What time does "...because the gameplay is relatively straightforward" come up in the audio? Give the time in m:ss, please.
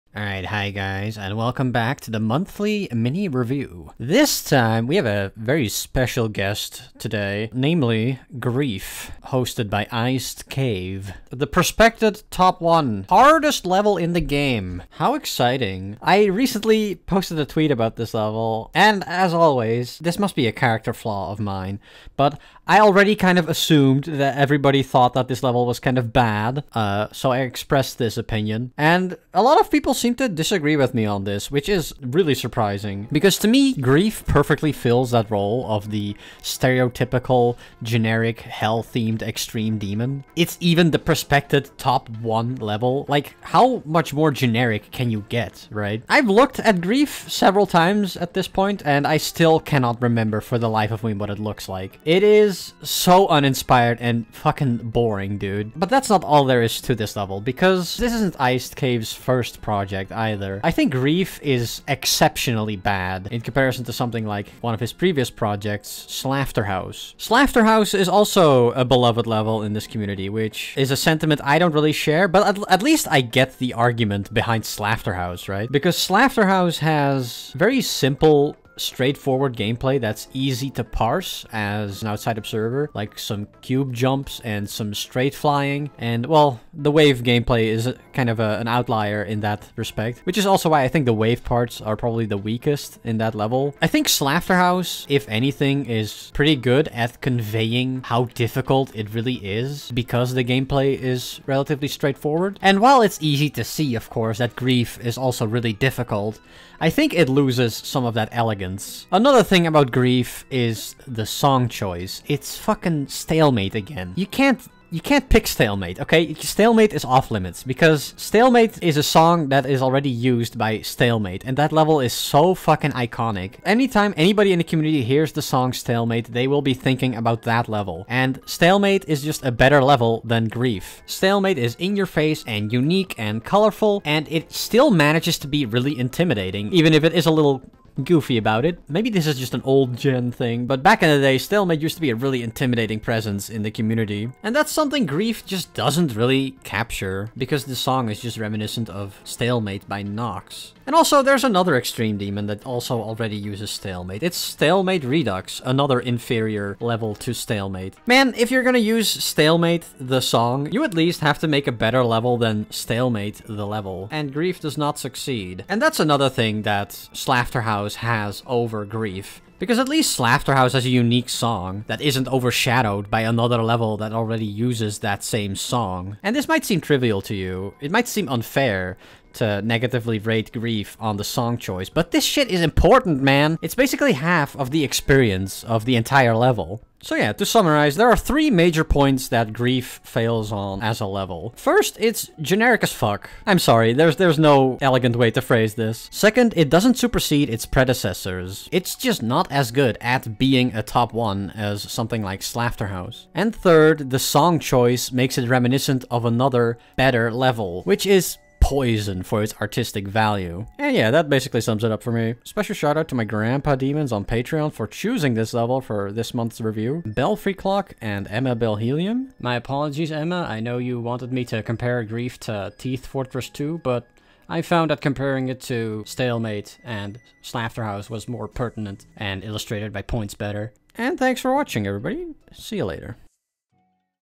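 1:39.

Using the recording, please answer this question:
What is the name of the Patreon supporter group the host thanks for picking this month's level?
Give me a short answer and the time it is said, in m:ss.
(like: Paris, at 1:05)
grandpa demons, at 3:33.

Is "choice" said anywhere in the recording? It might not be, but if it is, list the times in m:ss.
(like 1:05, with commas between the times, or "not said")
1:51, 3:01, 3:24.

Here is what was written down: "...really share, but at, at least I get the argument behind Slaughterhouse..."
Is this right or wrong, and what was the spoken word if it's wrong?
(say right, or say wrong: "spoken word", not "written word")
right.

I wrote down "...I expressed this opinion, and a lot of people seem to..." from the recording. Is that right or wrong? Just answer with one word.
right.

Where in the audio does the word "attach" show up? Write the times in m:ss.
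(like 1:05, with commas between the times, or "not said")
not said.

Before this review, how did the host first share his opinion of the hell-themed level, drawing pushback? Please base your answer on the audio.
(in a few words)
A tweet.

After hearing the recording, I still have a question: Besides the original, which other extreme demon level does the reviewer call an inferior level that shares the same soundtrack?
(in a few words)
Stalemate Redux.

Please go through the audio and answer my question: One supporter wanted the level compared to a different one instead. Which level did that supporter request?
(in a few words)
Teeth Fortress 2.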